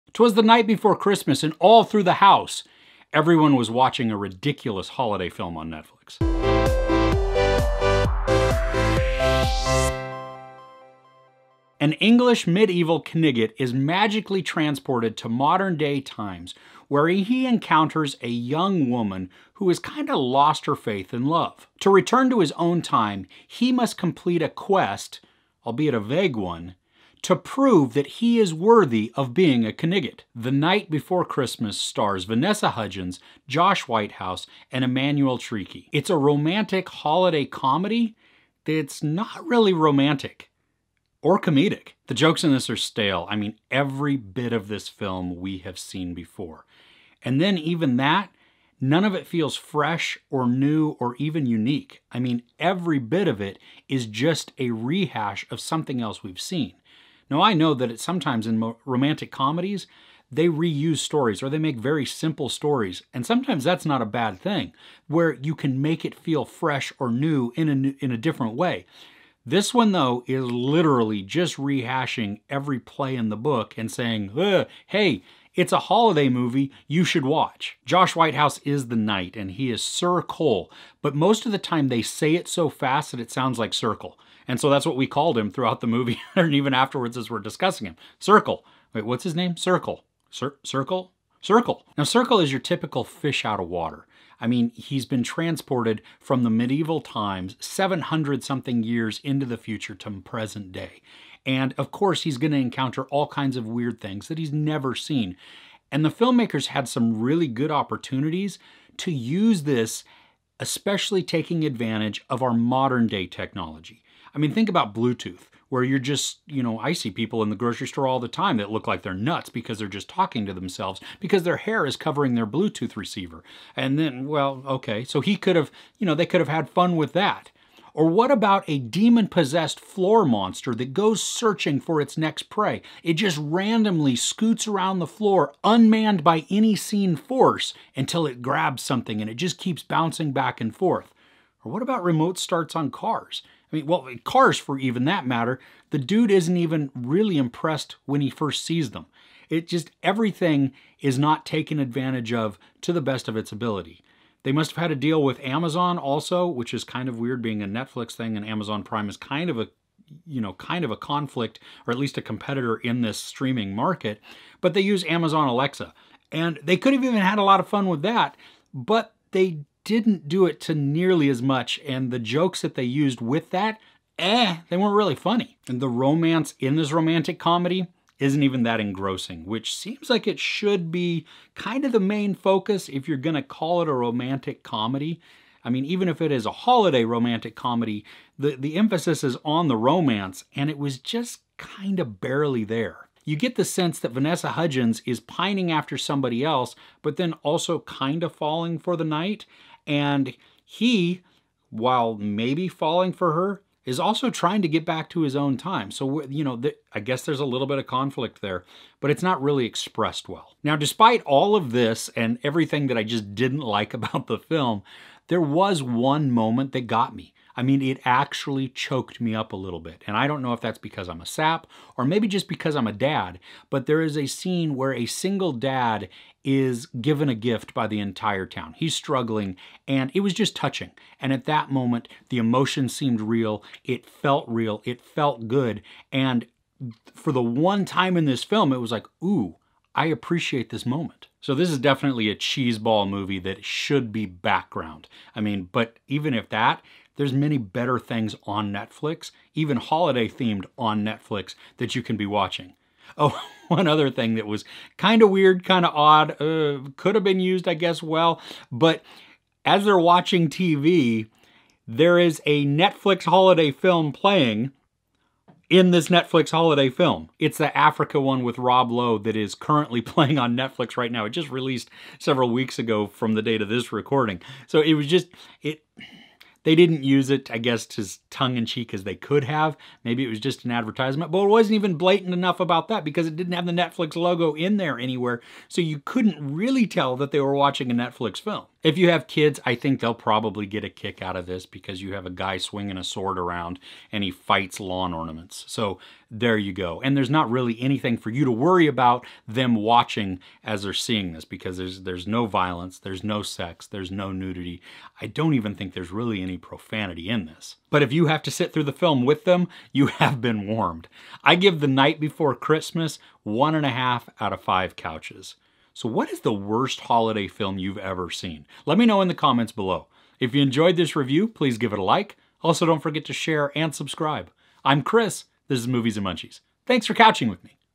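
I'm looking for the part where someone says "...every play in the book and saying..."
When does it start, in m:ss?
1:12.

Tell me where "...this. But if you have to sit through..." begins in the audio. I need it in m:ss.
5:07.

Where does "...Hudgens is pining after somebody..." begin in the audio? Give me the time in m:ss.
3:14.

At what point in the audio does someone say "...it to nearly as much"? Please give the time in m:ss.
2:50.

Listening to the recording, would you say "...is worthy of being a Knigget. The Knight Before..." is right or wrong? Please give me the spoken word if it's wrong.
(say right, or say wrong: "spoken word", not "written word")
right.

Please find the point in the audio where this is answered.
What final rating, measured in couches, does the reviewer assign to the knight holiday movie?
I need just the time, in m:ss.
5:13.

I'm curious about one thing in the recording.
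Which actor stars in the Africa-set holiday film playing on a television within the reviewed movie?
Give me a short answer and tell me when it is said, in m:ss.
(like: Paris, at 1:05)
Rob Lowe, at 4:28.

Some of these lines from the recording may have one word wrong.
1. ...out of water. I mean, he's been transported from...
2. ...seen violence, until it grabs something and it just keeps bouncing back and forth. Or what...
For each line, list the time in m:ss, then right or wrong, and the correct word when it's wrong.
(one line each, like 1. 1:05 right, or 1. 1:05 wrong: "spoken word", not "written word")
1. 1:33 right
2. 2:16 wrong: "force", not "violence".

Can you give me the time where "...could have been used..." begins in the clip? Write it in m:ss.
4:16.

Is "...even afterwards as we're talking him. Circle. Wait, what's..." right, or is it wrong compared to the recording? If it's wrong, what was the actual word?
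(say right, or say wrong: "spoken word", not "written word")
wrong: "discussing", not "talking".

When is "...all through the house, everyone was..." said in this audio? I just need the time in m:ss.
0:01.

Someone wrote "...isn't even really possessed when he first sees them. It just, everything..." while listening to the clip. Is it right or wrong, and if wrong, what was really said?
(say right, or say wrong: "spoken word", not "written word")
wrong: "impressed", not "possessed".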